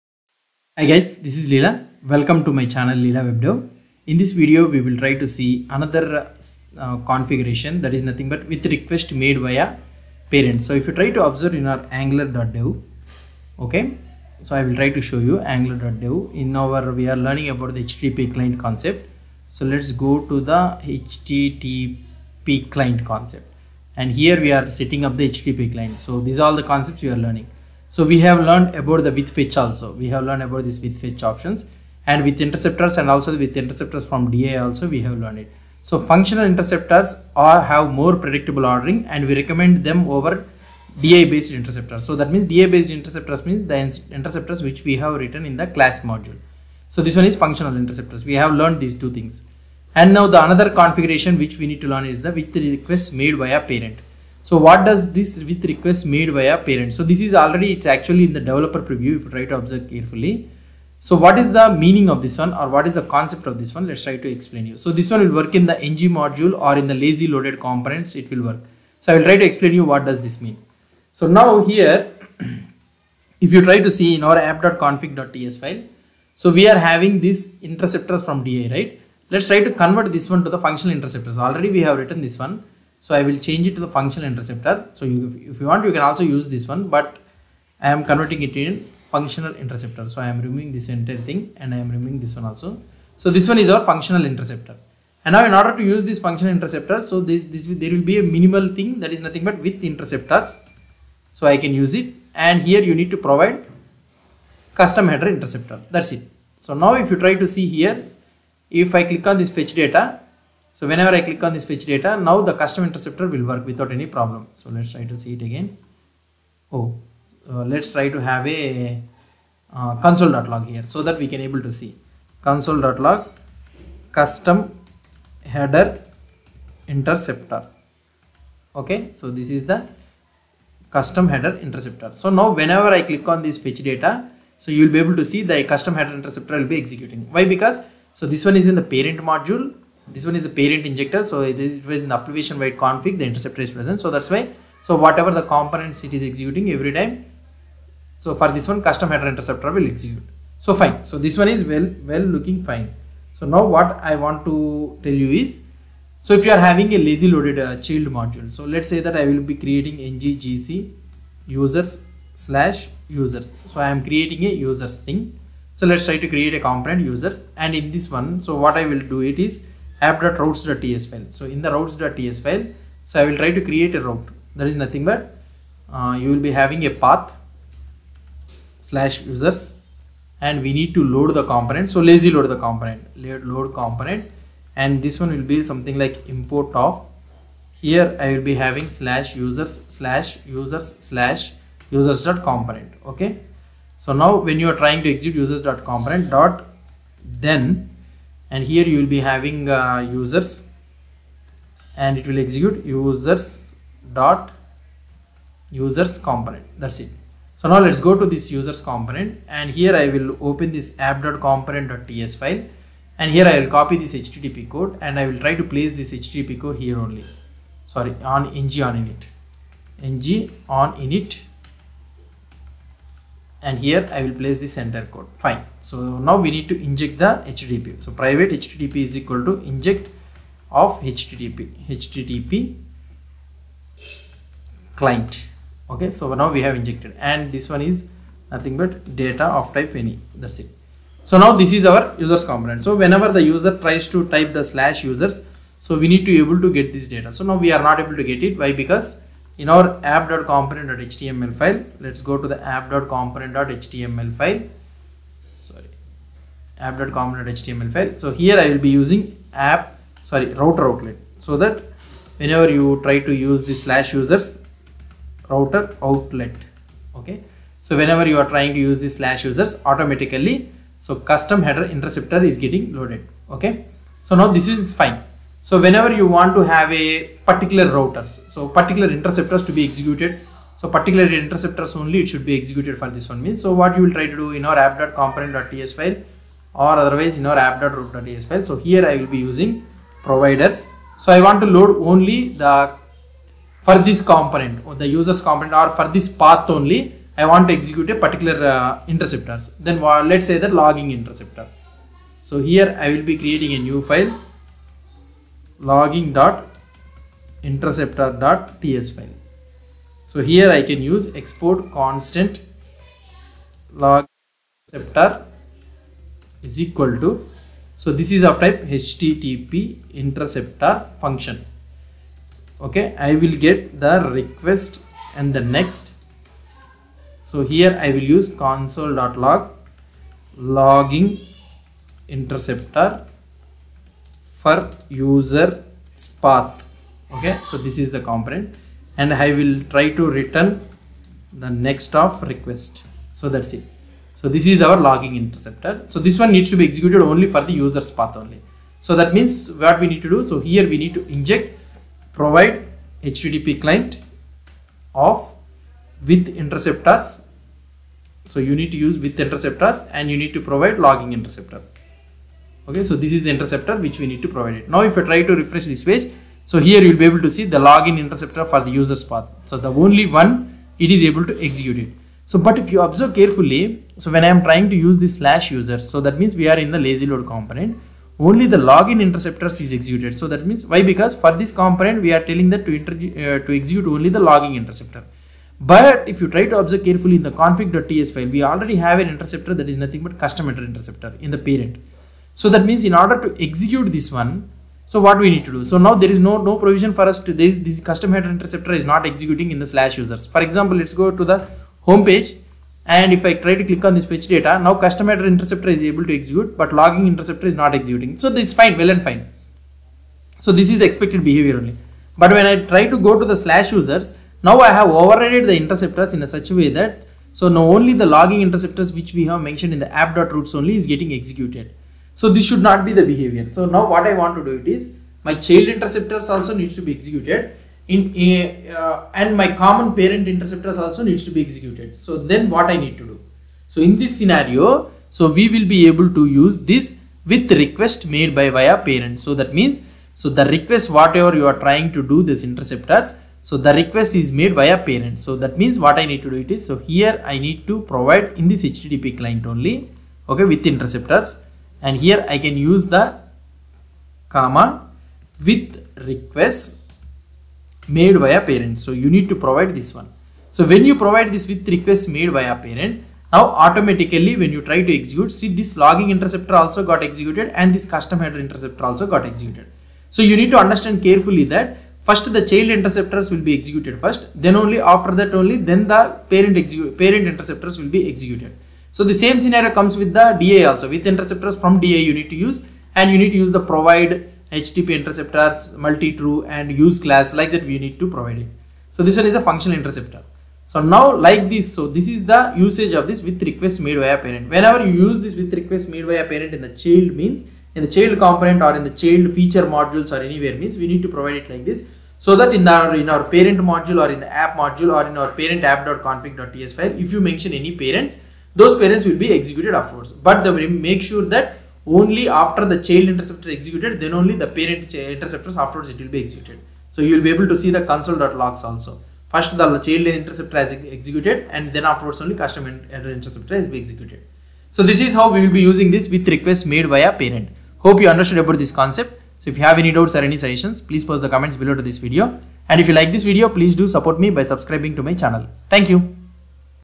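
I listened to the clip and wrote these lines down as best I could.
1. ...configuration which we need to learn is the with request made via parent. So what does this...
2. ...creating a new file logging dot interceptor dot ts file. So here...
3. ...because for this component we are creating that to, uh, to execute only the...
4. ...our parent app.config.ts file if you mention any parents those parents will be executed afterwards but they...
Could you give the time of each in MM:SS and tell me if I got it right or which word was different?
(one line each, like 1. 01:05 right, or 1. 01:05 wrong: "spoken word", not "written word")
1. 00:50 right
2. 05:03 right
3. 06:21 wrong: "telling", not "creating"
4. 08:25 right.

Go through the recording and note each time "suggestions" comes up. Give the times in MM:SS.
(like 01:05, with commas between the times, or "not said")
08:50.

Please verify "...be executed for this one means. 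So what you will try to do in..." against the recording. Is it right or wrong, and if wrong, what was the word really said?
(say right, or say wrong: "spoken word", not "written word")
right.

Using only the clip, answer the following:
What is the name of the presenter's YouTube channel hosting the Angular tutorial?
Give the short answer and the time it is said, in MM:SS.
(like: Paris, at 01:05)
Leela WebDev, at 00:02.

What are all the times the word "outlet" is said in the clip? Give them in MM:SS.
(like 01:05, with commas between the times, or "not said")
04:20, 04:26.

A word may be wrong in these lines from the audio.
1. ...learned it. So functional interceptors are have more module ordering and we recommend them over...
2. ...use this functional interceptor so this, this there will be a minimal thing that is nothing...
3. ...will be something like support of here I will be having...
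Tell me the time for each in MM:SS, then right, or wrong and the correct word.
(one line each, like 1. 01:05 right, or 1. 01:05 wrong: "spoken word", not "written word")
1. 00:35 wrong: "predictable", not "module"
2. 01:35 right
3. 03:05 wrong: "import", not "support".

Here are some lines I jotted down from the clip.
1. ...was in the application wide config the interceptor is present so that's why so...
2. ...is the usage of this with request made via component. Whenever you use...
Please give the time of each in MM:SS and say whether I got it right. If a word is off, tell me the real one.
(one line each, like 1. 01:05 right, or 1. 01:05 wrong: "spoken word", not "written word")
1. 02:21 right
2. 08:12 wrong: "parent", not "component".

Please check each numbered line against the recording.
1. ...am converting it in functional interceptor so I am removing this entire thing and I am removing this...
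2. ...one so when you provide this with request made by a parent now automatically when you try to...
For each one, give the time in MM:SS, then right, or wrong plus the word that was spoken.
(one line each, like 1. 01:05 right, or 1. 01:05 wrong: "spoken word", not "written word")
1. 01:27 right
2. 07:40 right.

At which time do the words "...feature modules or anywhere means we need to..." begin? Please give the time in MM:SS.
08:19.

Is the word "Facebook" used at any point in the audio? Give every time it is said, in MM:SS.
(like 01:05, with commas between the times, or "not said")
not said.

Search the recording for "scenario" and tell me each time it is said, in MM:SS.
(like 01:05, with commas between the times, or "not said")
07:14, 07:59.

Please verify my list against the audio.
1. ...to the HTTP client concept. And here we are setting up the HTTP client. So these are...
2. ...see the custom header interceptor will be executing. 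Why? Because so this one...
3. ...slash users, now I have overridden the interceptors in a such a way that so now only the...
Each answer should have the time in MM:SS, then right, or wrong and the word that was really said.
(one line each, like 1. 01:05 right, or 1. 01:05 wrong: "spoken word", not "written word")
1. 00:20 right
2. 02:15 right
3. 06:53 right.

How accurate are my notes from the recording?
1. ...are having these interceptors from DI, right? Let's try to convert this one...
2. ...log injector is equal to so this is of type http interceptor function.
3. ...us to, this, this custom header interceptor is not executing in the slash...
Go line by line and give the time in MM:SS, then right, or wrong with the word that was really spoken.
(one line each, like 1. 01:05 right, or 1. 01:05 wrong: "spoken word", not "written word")
1. 01:16 right
2. 05:13 wrong: "interceptor", not "injector"
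3. 06:37 right.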